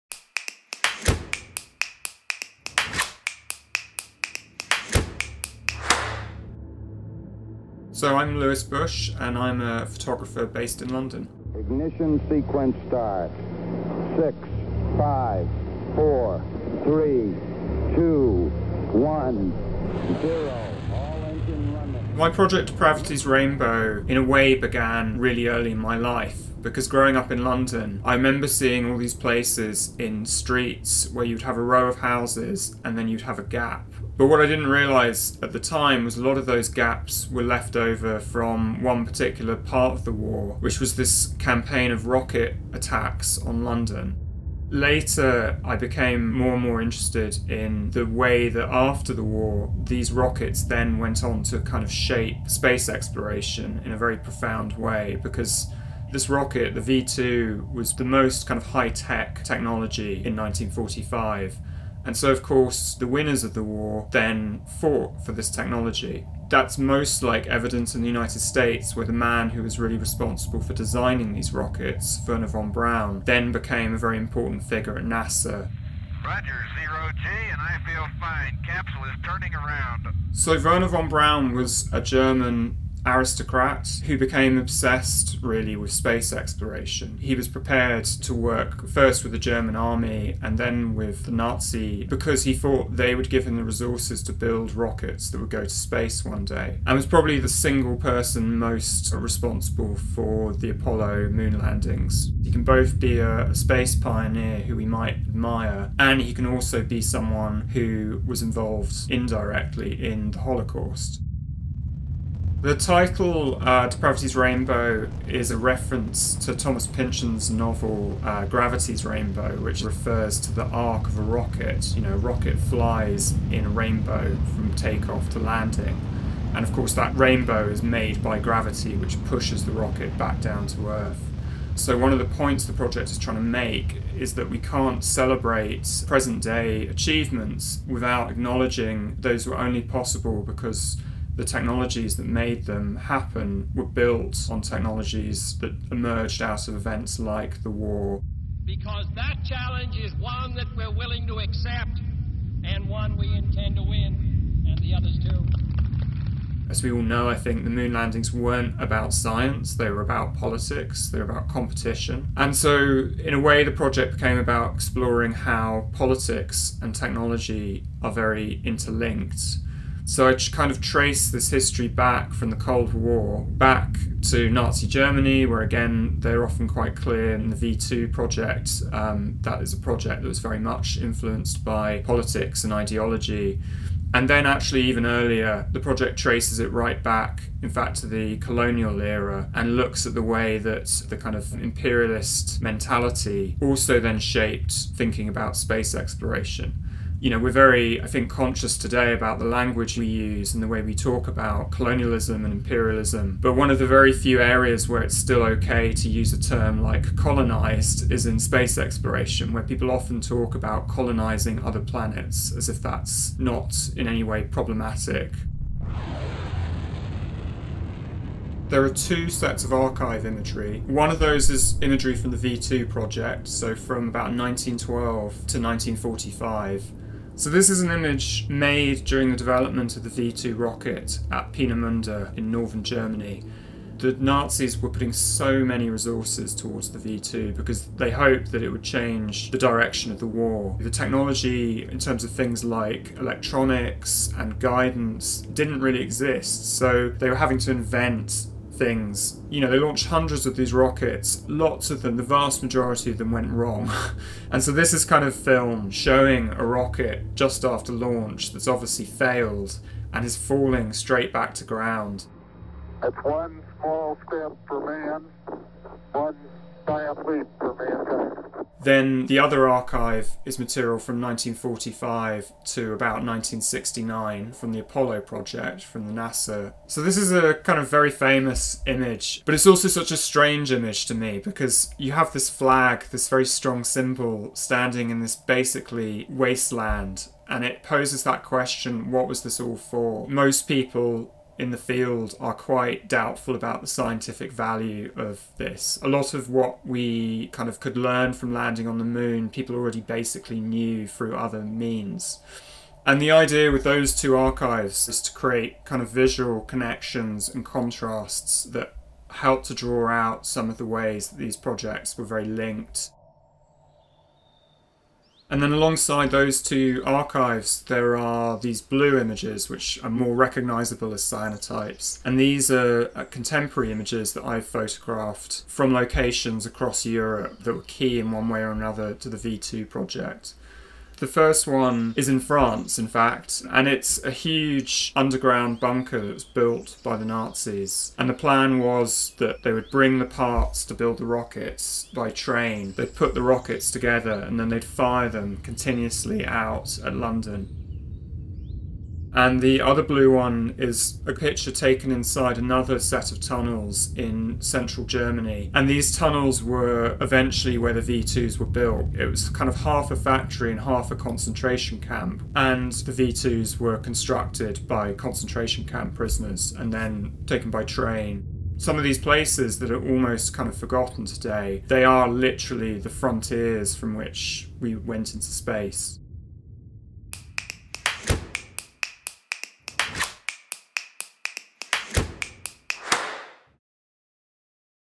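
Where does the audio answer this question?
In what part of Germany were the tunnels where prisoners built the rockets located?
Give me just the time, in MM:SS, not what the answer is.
05:54.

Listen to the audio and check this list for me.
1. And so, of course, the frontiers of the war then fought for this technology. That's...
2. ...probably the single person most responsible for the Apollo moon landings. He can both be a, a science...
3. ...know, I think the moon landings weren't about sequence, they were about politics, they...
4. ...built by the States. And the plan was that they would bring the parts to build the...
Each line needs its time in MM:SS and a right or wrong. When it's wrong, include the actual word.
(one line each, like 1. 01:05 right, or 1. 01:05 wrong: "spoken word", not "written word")
1. 01:02 wrong: "winners", not "frontiers"
2. 01:37 wrong: "space", not "science"
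3. 02:37 wrong: "science", not "sequence"
4. 05:36 wrong: "Nazis", not "States".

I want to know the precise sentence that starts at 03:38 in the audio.
There are two sets of archive imagery.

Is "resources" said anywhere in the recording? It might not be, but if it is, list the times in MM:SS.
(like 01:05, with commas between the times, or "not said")
01:33, 03:55.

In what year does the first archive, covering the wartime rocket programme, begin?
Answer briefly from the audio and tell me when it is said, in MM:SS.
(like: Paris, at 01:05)
1912, at 03:44.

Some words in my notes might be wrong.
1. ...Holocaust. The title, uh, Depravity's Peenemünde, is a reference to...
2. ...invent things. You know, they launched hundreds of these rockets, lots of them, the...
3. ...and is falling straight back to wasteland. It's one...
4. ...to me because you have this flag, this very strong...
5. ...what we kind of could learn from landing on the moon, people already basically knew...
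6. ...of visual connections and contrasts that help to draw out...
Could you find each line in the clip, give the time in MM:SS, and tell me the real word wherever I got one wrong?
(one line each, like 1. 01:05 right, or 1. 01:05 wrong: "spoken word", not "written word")
1. 01:50 wrong: "Rainbow", not "Peenemünde"
2. 04:07 right
3. 04:20 wrong: "ground", not "wasteland"
4. 04:41 right
5. 04:56 right
6. 05:06 right.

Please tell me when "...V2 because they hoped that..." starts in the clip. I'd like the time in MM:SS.
03:56.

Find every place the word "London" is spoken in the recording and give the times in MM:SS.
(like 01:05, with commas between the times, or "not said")
00:10, 00:27, 00:43, 05:47.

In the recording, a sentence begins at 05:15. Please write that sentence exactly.
And then alongside those two archives, there are these blue images, which are more recognizable as cyanotypes.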